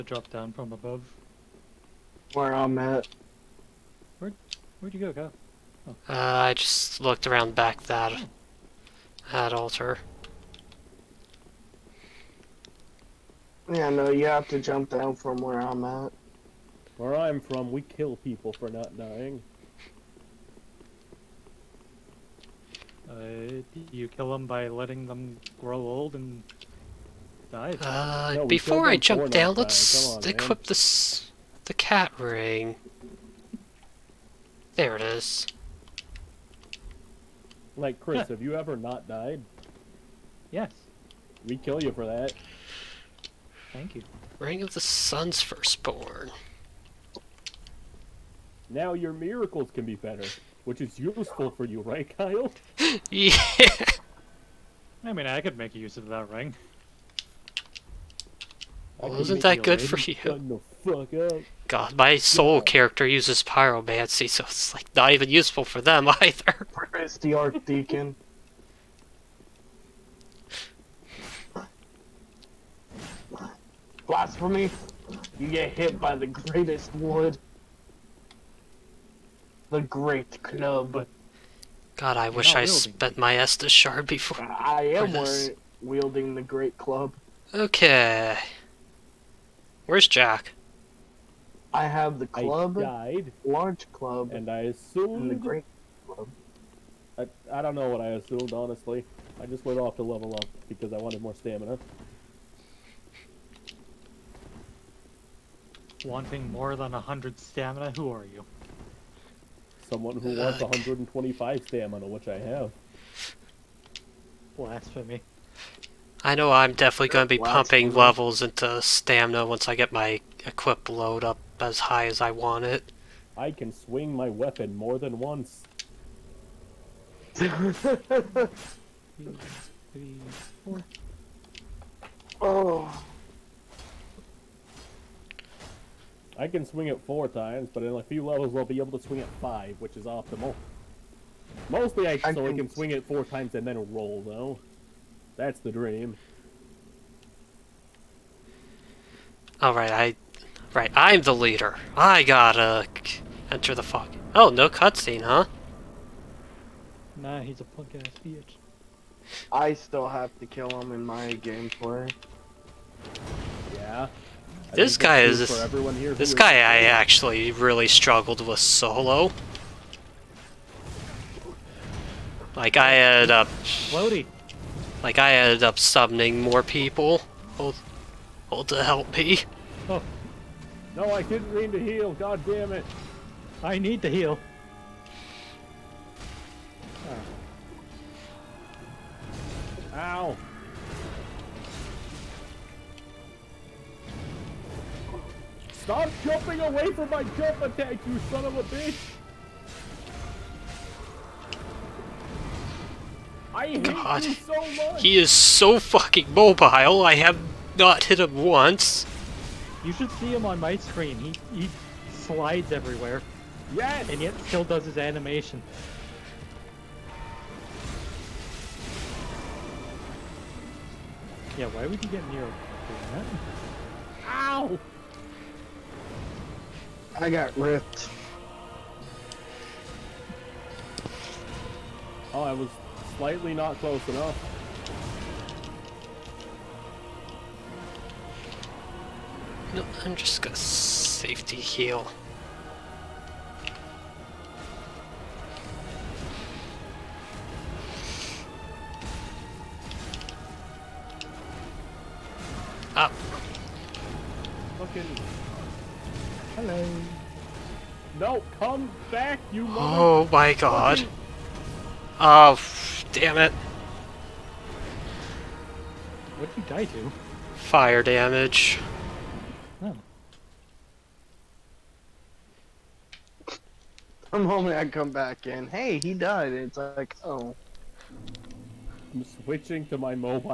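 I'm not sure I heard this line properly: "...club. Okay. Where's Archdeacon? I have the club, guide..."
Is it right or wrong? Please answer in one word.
wrong.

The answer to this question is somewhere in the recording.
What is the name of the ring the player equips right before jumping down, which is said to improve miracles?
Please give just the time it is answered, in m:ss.
0:44.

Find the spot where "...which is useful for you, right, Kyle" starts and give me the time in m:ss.
0:50.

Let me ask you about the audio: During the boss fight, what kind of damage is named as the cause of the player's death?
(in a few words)
Fire damage.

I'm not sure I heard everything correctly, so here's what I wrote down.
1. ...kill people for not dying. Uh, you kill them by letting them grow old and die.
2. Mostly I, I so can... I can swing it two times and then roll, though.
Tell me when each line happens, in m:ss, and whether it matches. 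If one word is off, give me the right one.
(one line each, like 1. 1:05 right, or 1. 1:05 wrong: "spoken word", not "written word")
1. 0:17 right
2. 2:21 wrong: "four", not "two".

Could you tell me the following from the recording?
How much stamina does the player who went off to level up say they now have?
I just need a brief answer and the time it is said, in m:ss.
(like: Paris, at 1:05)
125, at 1:50.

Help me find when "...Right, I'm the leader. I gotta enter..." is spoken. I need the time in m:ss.
2:30.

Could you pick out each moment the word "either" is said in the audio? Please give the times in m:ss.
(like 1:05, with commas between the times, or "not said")
1:06.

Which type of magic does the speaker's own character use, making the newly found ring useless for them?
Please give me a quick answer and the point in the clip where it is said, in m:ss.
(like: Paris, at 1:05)
Pyromancy, at 1:03.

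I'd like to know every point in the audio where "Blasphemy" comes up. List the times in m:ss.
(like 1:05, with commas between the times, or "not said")
1:14, 1:54.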